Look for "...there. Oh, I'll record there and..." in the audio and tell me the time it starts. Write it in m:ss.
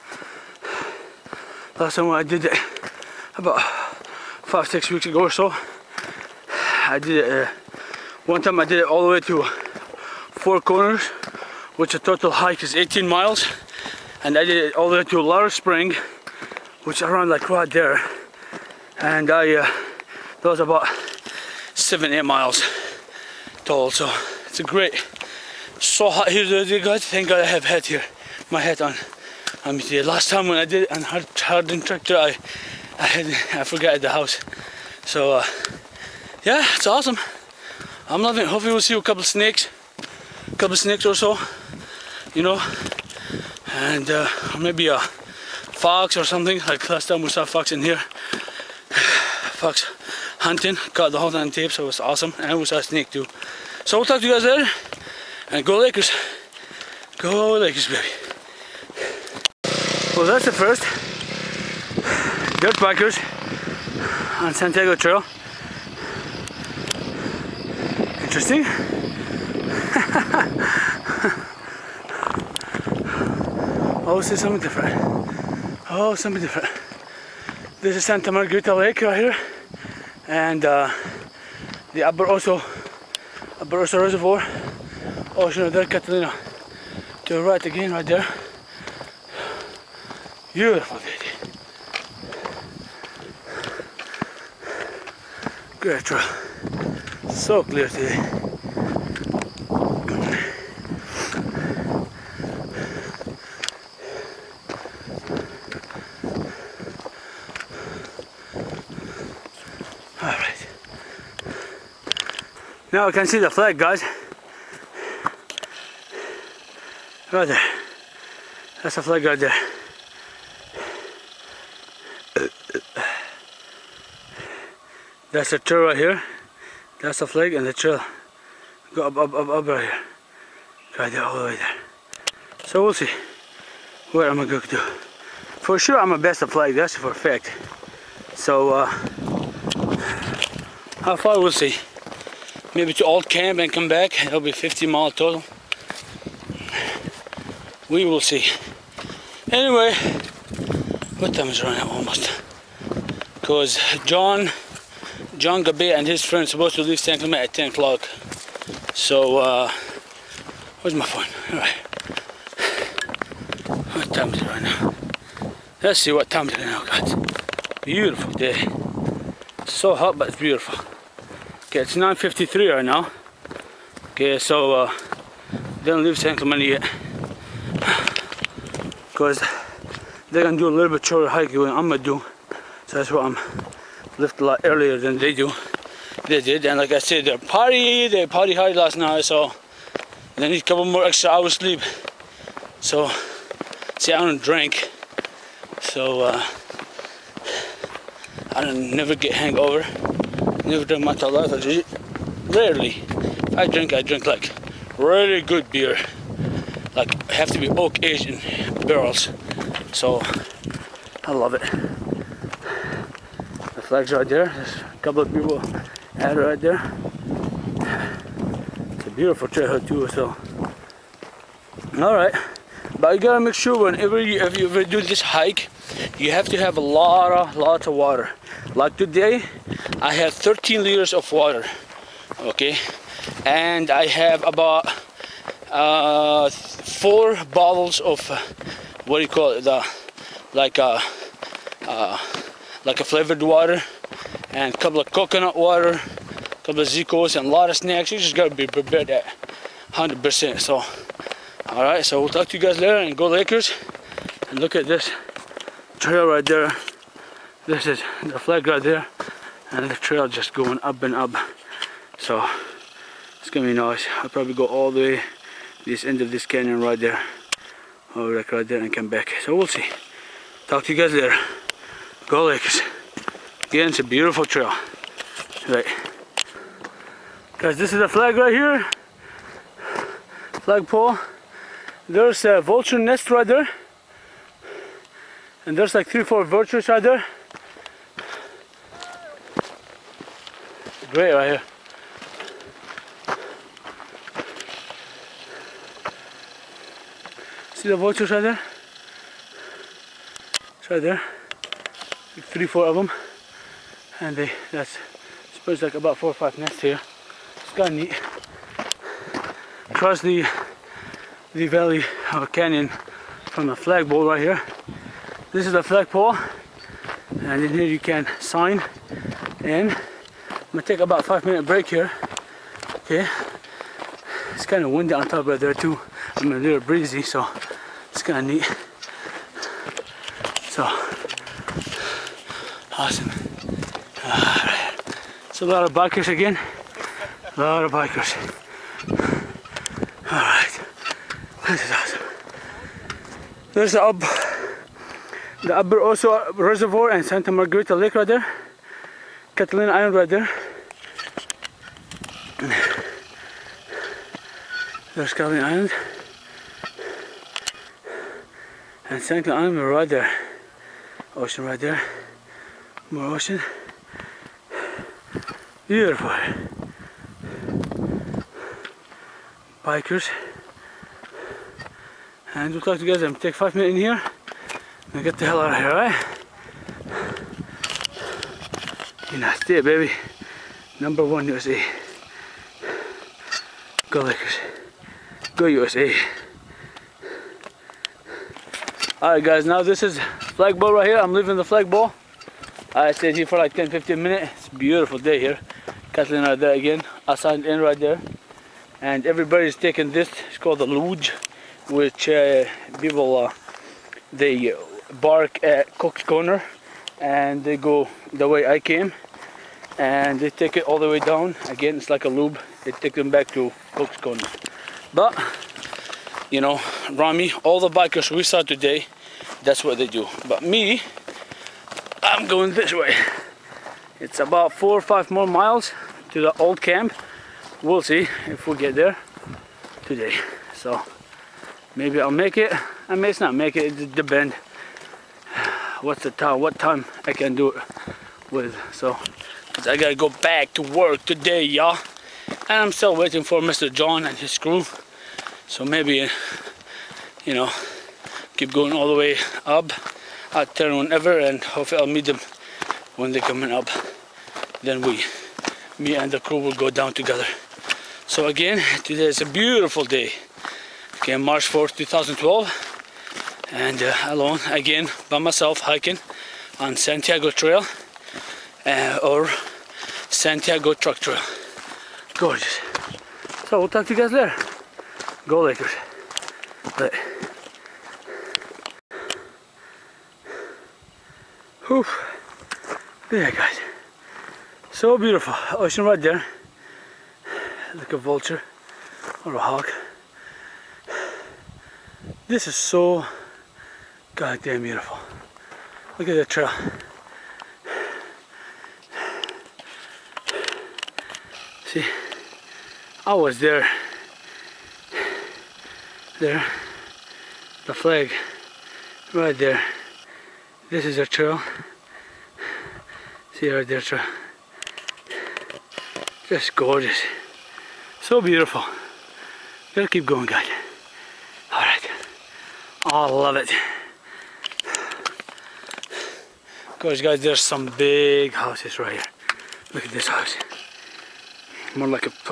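4:27.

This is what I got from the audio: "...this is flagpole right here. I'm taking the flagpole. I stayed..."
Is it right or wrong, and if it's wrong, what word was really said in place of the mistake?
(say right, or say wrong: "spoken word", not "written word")
wrong: "leaving", not "taking".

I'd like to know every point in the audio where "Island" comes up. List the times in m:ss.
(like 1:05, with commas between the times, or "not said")
5:49, 5:55.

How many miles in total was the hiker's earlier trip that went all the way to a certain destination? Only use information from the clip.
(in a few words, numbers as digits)
18 miles.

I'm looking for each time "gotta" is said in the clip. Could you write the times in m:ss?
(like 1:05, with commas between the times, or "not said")
3:43, 4:08, 7:19, 8:39.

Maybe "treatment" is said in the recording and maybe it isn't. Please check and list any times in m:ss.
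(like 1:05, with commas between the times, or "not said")
not said.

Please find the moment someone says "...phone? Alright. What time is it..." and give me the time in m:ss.
2:41.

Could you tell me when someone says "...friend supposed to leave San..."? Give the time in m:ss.
2:36.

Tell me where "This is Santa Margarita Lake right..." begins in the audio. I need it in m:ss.
1:17.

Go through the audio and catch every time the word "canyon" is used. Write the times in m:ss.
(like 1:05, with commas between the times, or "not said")
4:26, 5:12.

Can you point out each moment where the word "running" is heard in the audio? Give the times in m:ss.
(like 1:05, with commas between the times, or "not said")
2:31.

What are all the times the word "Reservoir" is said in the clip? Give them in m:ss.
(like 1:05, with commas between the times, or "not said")
1:24, 5:46.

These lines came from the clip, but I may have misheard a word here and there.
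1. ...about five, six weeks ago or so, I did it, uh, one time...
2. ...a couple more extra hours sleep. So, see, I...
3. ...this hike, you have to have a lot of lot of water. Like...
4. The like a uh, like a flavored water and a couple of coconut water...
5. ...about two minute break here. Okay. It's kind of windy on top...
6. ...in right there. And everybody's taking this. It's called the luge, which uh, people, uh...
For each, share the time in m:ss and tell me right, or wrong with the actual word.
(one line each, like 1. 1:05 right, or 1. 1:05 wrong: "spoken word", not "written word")
1. 0:03 right
2. 3:10 right
3. 3:45 right
4. 3:59 right
5. 5:21 wrong: "five", not "two"
6. 6:37 right.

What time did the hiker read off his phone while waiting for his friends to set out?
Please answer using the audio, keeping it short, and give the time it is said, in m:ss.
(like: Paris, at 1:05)
9:53, at 2:51.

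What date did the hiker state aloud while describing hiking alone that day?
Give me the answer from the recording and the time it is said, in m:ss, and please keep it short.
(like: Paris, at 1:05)
March 4th, 2012, at 7:41.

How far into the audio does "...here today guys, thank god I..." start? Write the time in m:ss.
0:26.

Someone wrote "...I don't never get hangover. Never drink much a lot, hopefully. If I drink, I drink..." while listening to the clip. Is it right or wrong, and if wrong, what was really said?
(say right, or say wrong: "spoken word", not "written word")
wrong: "rarely", not "hopefully".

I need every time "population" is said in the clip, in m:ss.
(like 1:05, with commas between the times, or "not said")
not said.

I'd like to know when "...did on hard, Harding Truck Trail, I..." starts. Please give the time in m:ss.
0:30.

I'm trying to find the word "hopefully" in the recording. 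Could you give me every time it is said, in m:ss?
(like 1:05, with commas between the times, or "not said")
0:38, 7:31.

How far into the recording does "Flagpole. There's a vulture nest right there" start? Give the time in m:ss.
4:40.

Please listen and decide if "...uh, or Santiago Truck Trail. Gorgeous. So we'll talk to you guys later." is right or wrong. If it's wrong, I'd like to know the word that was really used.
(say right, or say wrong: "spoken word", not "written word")
right.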